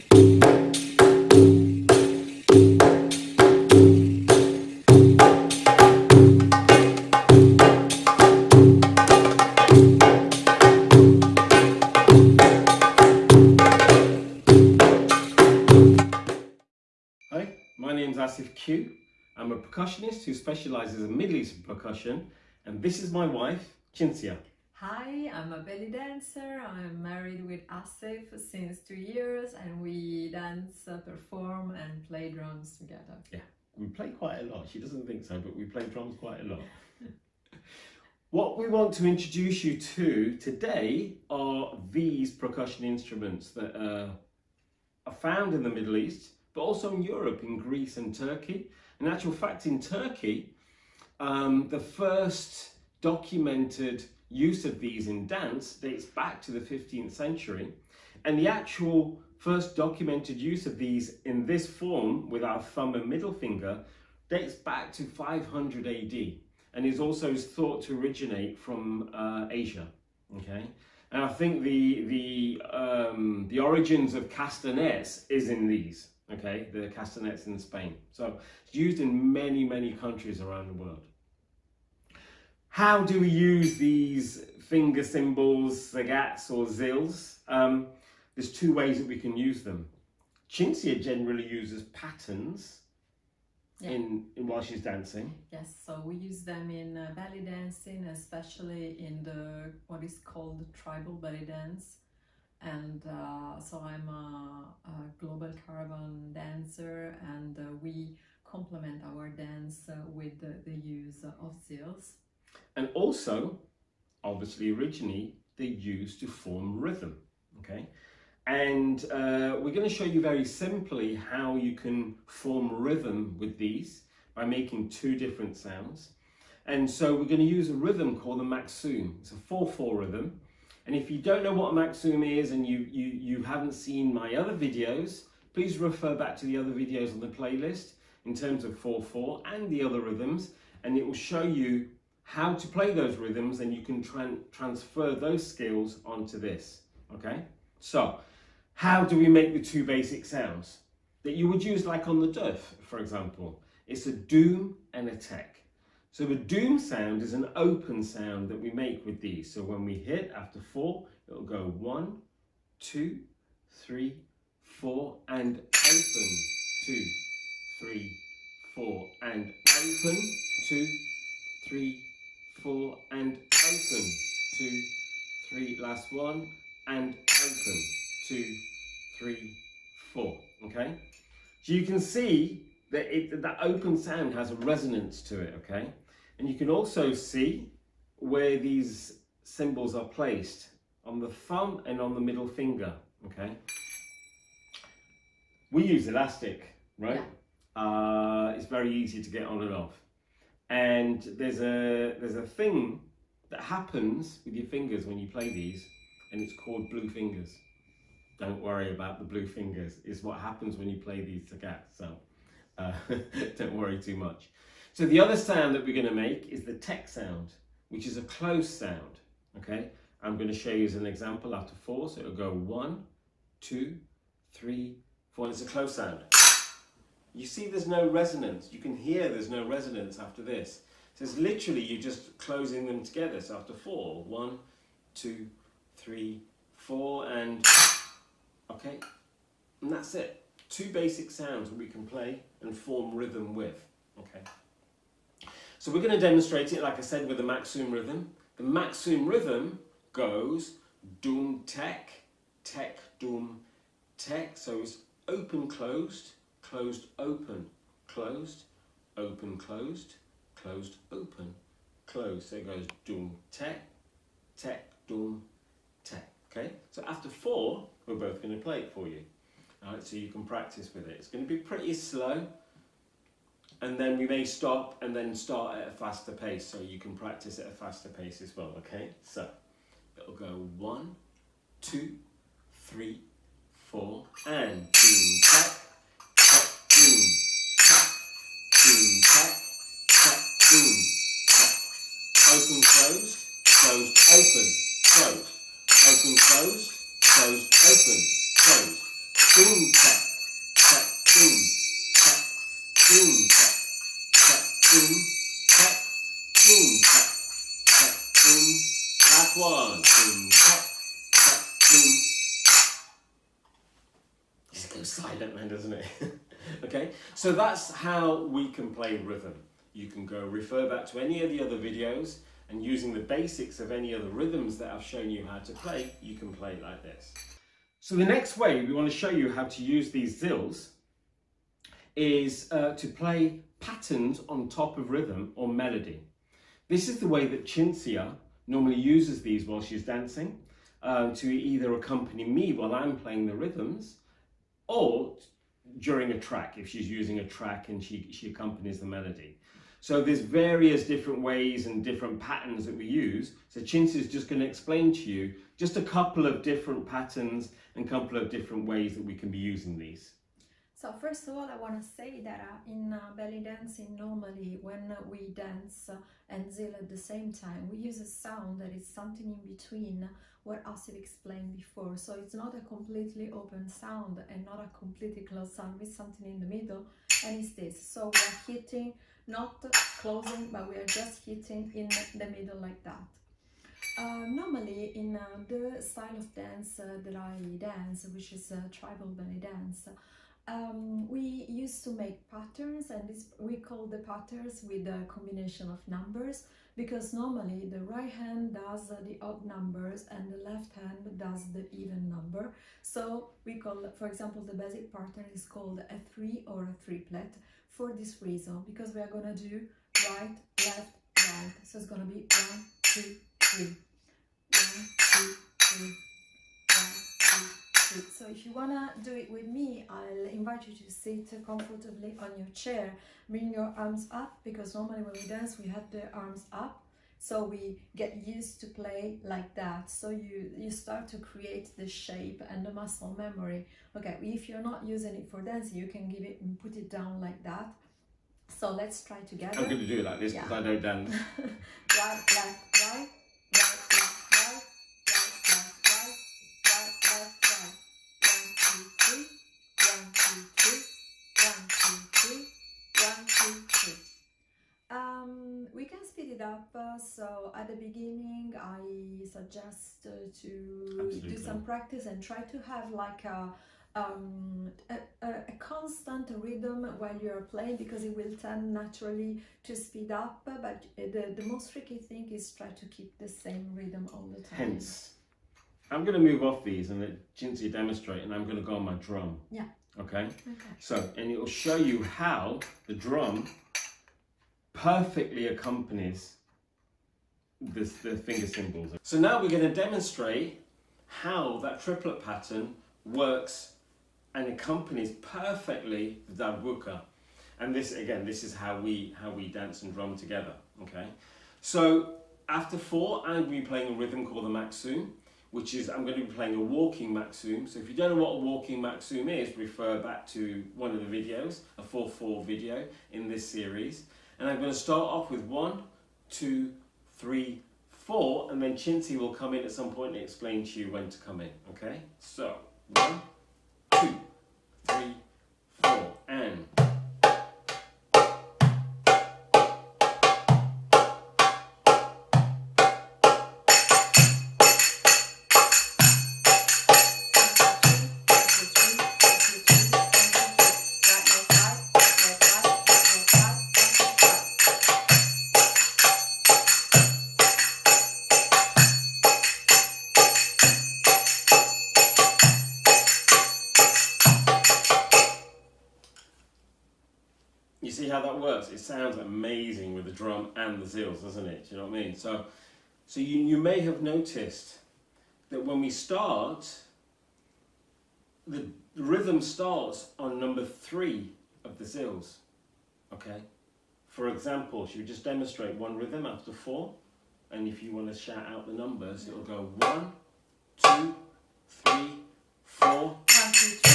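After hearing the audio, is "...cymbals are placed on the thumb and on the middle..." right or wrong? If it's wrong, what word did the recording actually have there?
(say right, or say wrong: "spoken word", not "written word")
right.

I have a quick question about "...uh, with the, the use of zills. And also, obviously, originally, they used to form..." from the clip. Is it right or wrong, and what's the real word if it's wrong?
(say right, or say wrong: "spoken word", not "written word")
right.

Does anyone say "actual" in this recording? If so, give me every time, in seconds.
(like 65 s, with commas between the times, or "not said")
49 s, 58 s.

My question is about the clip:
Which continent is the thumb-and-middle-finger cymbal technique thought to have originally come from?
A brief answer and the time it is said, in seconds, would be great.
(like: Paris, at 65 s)
Asia, at 69 s.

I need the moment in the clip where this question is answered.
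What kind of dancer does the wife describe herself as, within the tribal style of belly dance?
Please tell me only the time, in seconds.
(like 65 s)
105 s.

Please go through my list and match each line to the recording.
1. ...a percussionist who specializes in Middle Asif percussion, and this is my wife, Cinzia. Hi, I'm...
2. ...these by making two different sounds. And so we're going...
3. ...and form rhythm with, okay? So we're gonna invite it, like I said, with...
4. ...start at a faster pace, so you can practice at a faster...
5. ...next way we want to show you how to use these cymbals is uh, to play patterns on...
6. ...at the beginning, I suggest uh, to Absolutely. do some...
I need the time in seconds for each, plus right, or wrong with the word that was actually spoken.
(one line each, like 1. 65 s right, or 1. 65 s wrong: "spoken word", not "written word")
1. 19 s wrong: "Eastern", not "Asif"
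2. 123 s right
3. 242 s wrong: "demonstrate", not "invite"
4. 275 s right
5. 328 s wrong: "zills", not "cymbals"
6. 457 s right.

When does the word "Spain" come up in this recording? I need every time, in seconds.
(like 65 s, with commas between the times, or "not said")
77 s.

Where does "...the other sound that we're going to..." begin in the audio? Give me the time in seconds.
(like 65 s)
215 s.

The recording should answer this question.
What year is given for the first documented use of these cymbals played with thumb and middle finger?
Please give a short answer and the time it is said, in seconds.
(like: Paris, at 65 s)
500 AD, at 65 s.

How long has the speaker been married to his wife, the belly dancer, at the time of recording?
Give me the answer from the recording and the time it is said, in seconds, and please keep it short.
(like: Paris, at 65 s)
2 years, at 28 s.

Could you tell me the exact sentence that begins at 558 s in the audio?
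It sounds amazing with the drum and the zills, doesn't it?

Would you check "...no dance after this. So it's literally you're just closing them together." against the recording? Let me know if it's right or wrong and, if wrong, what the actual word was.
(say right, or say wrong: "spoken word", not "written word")
wrong: "resonance", not "dance".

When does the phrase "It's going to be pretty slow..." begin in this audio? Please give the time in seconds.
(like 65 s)
271 s.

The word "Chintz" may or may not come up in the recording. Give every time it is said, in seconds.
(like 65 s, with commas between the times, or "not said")
353 s.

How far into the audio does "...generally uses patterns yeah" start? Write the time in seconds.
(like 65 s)
91 s.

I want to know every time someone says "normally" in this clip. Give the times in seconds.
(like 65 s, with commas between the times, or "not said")
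338 s, 364 s, 384 s, 397 s, 424 s.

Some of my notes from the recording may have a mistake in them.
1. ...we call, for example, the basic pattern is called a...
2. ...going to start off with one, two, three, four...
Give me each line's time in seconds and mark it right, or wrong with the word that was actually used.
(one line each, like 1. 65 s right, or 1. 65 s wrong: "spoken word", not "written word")
1. 403 s right
2. 514 s right.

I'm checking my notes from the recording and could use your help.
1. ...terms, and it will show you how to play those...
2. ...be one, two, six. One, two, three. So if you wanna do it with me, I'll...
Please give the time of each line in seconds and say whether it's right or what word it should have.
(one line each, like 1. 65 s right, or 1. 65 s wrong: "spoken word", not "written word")
1. 140 s wrong: "rhythms", not "terms"
2. 412 s wrong: "three", not "six".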